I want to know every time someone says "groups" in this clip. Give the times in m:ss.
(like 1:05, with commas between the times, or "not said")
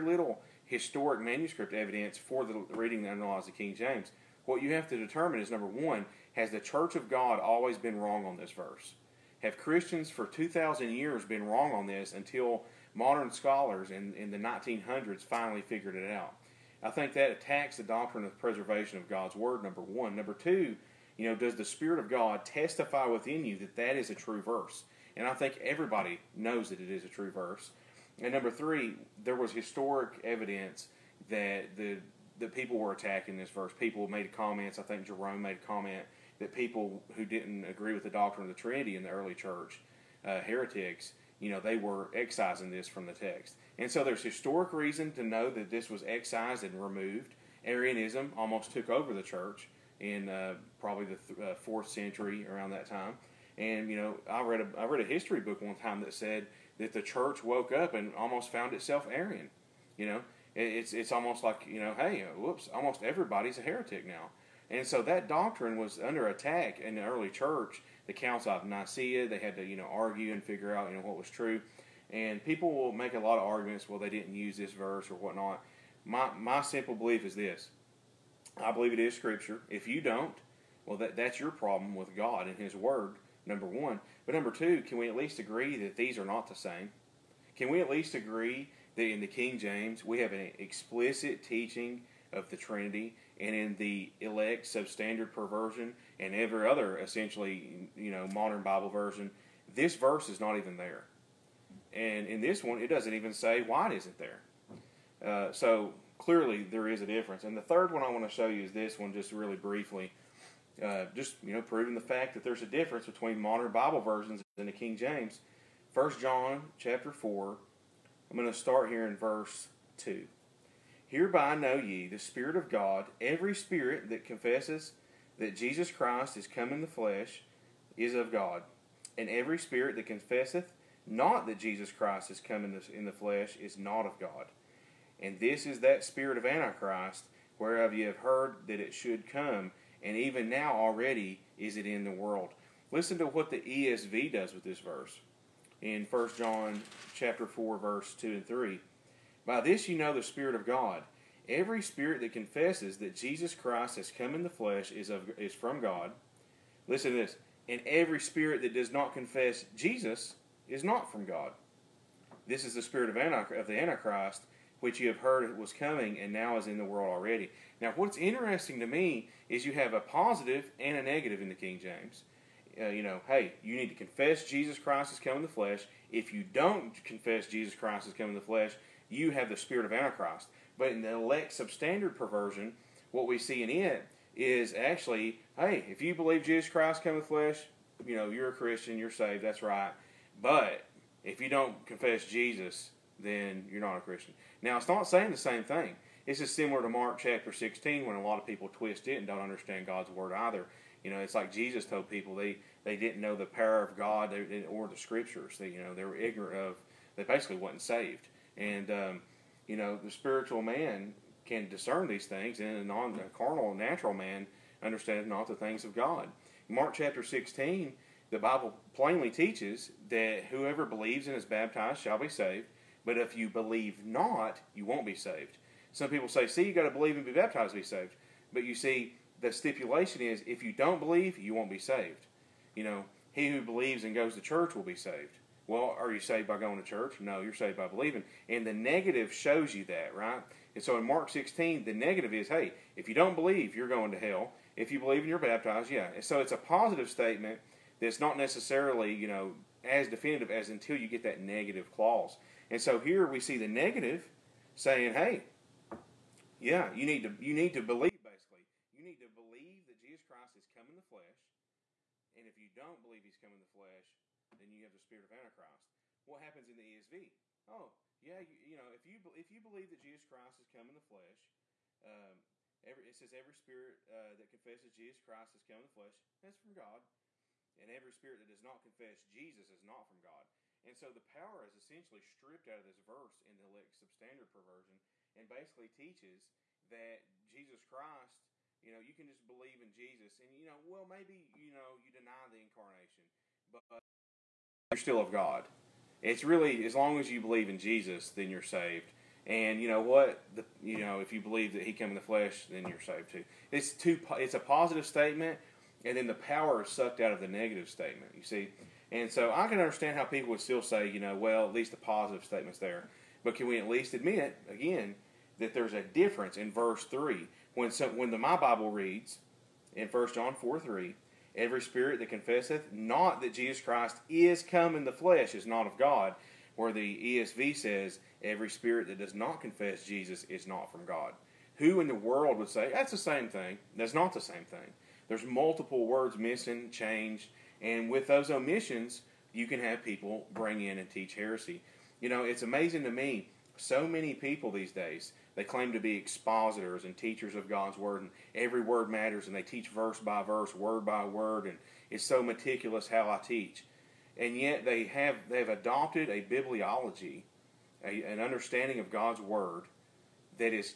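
not said.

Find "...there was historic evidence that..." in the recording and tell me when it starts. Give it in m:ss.
0:29.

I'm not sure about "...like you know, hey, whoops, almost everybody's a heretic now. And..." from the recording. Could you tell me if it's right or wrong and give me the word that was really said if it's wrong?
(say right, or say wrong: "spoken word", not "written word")
right.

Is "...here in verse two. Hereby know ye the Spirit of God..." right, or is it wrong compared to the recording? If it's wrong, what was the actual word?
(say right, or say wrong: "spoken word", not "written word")
right.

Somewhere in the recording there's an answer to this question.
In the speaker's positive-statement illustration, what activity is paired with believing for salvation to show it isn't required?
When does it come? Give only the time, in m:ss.
3:54.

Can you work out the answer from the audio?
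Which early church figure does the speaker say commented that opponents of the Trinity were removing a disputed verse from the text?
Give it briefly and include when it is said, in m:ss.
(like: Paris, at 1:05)
Jerome, at 0:35.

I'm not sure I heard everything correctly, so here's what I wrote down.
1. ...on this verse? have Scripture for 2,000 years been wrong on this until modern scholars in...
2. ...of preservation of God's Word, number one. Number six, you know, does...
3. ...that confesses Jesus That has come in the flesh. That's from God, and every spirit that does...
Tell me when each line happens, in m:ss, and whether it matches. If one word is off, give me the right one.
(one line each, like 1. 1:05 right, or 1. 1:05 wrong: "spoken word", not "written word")
1. 0:08 wrong: "Christians", not "Scripture"
2. 0:18 wrong: "two", not "six"
3. 4:34 wrong: "Christ", not "That".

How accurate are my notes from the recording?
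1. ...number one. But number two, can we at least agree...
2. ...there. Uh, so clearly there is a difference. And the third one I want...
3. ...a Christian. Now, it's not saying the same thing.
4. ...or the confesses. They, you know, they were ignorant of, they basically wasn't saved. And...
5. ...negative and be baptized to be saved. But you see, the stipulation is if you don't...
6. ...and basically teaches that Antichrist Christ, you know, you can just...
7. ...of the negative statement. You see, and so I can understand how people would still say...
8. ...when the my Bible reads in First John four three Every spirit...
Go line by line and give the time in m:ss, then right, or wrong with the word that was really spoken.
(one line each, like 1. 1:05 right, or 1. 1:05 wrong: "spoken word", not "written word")
1. 1:23 right
2. 1:44 right
3. 3:13 right
4. 3:24 wrong: "scriptures", not "confesses"
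5. 3:46 wrong: "believe", not "negative"
6. 4:45 wrong: "Jesus", not "Antichrist"
7. 5:07 right
8. 5:18 right.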